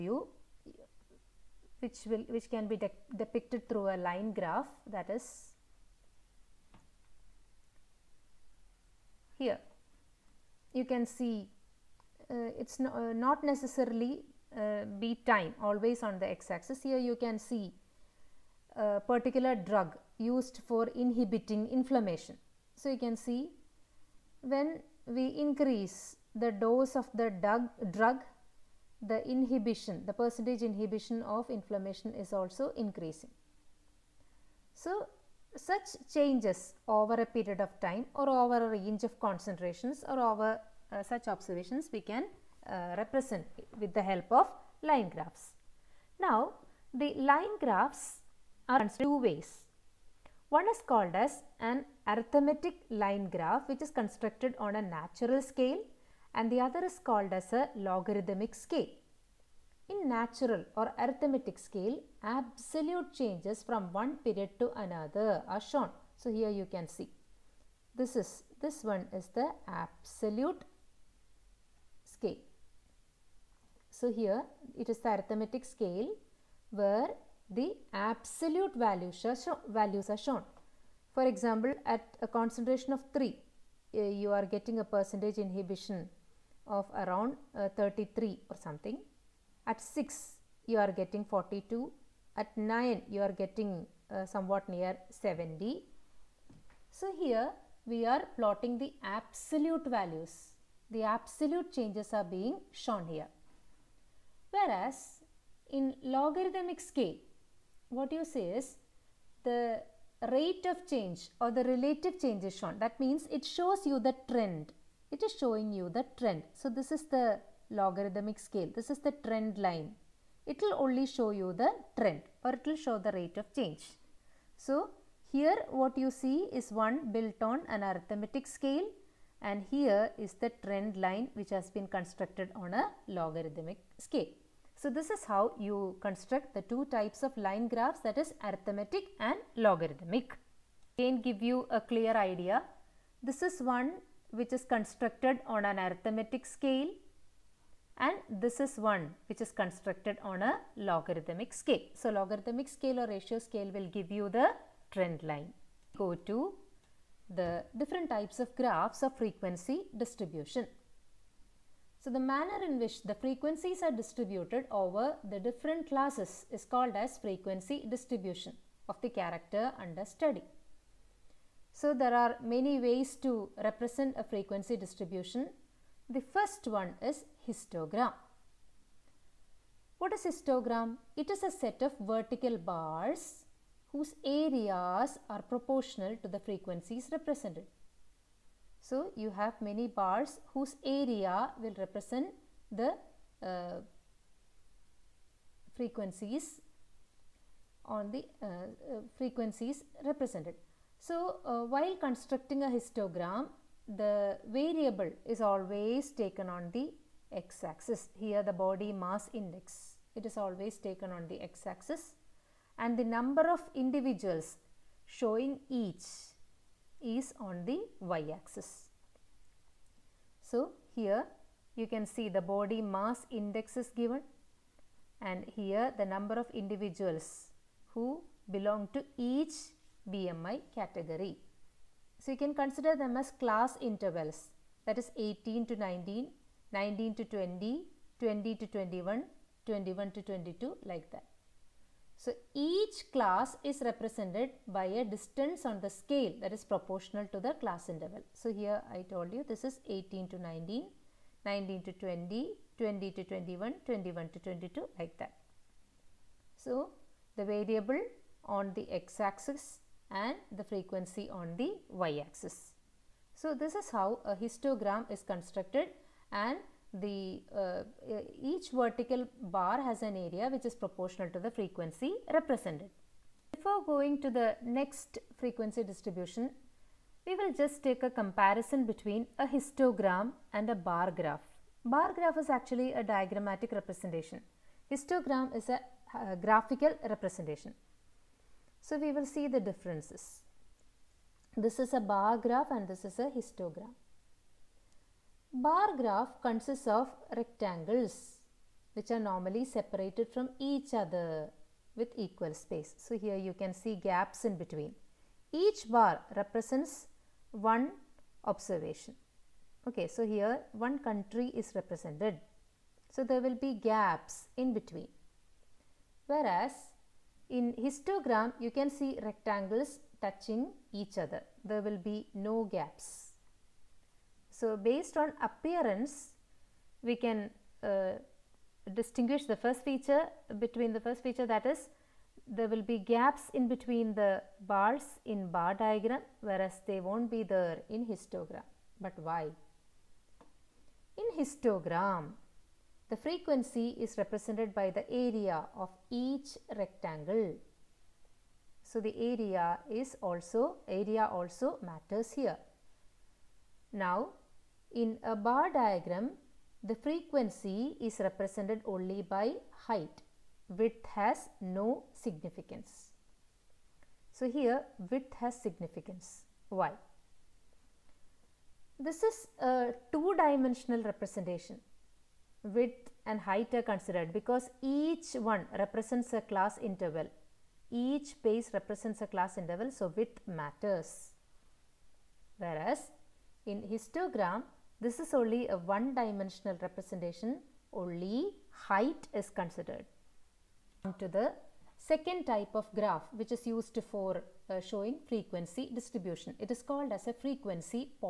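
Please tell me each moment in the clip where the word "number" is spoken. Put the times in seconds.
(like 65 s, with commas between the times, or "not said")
213 s, 226 s.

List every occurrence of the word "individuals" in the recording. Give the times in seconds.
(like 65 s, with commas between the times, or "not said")
213 s, 226 s.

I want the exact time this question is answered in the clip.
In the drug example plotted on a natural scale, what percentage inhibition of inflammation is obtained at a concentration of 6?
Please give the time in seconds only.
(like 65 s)
91 s.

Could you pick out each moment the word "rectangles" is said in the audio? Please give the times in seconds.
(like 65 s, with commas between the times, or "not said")
297 s, 319 s, 346 s.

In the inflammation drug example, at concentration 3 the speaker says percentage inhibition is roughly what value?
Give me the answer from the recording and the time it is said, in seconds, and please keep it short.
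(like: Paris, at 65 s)
33, at 87 s.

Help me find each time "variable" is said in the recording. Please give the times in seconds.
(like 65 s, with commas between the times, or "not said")
204 s, 257 s.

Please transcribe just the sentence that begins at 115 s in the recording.
It is showing you the trend.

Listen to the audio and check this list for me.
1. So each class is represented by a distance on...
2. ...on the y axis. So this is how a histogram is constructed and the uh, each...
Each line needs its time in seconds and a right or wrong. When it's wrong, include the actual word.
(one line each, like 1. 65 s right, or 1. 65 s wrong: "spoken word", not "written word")
1. 242 s right
2. 261 s right.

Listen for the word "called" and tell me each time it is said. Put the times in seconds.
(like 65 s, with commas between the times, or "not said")
50 s, 57 s, 166 s, 396 s.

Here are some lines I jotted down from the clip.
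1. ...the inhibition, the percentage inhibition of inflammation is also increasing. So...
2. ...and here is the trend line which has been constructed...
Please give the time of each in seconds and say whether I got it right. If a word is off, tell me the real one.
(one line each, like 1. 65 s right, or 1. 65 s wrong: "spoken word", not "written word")
1. 29 s right
2. 129 s right.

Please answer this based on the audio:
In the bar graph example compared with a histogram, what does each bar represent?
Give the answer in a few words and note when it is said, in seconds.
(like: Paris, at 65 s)
one country, at 310 s.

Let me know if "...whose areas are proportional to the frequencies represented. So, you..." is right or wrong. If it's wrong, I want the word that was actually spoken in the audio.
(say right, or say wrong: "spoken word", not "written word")
right.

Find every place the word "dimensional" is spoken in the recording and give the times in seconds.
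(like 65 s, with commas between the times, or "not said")
370 s, 386 s.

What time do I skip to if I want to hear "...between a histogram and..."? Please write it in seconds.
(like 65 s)
278 s.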